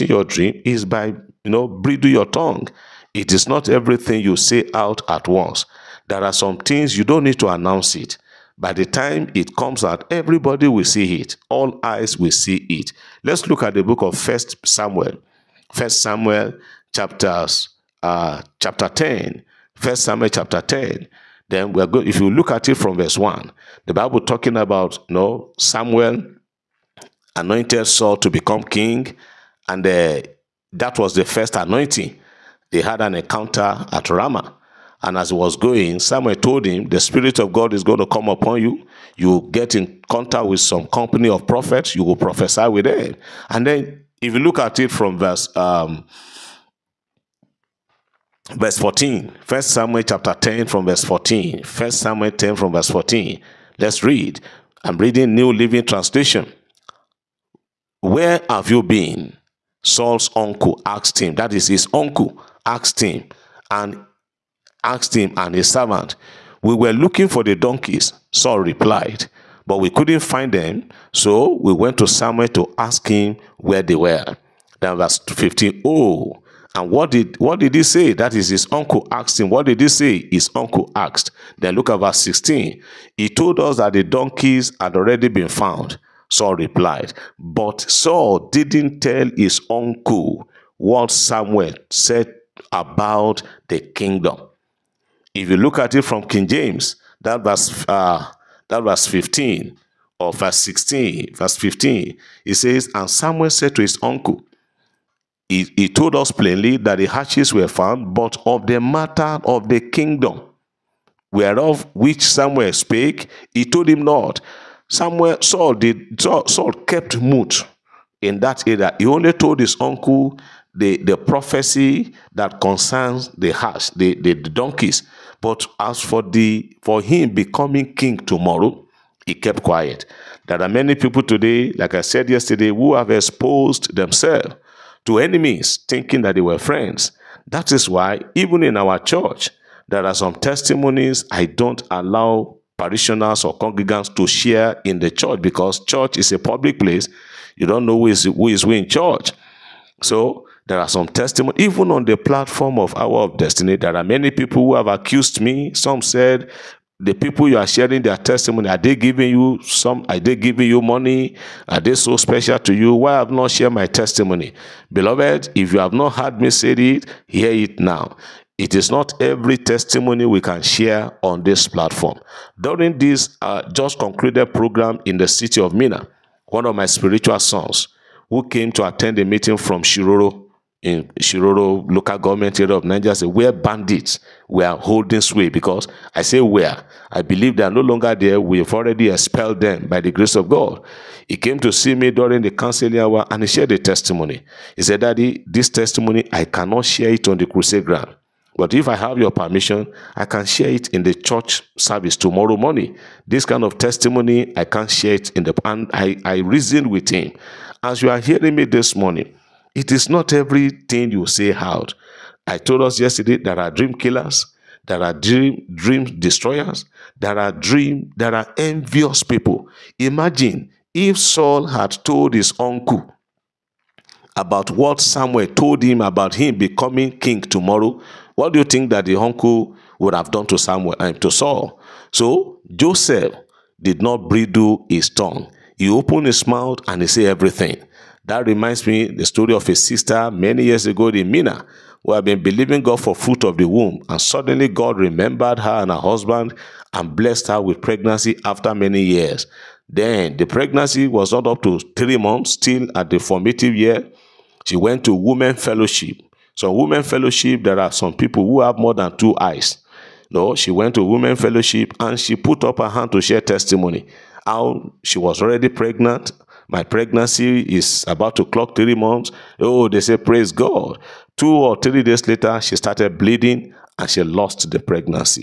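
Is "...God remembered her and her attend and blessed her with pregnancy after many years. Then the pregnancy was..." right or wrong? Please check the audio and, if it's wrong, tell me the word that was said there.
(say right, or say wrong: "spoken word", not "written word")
wrong: "husband", not "attend".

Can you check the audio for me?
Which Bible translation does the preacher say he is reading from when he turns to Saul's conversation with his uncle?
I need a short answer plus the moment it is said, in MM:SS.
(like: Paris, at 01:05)
New Living Translation, at 00:55.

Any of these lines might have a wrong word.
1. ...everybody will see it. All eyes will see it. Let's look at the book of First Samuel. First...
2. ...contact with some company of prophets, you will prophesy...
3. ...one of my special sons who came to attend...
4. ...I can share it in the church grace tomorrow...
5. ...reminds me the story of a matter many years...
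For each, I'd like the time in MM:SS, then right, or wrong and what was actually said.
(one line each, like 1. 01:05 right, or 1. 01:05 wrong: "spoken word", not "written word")
1. 00:10 right
2. 00:40 right
3. 02:56 wrong: "spiritual", not "special"
4. 03:20 wrong: "service", not "grace"
5. 03:58 wrong: "sister", not "matter".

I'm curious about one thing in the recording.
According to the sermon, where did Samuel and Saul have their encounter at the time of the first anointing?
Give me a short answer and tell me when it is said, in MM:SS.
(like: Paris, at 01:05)
Ramah, at 00:34.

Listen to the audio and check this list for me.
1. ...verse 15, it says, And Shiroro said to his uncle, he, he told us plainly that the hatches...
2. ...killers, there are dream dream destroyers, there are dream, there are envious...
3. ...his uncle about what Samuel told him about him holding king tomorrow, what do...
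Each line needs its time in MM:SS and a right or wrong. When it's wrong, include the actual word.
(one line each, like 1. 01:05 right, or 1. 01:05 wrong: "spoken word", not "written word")
1. 01:41 wrong: "Samuel", not "Shiroro"
2. 03:33 right
3. 03:42 wrong: "becoming", not "holding".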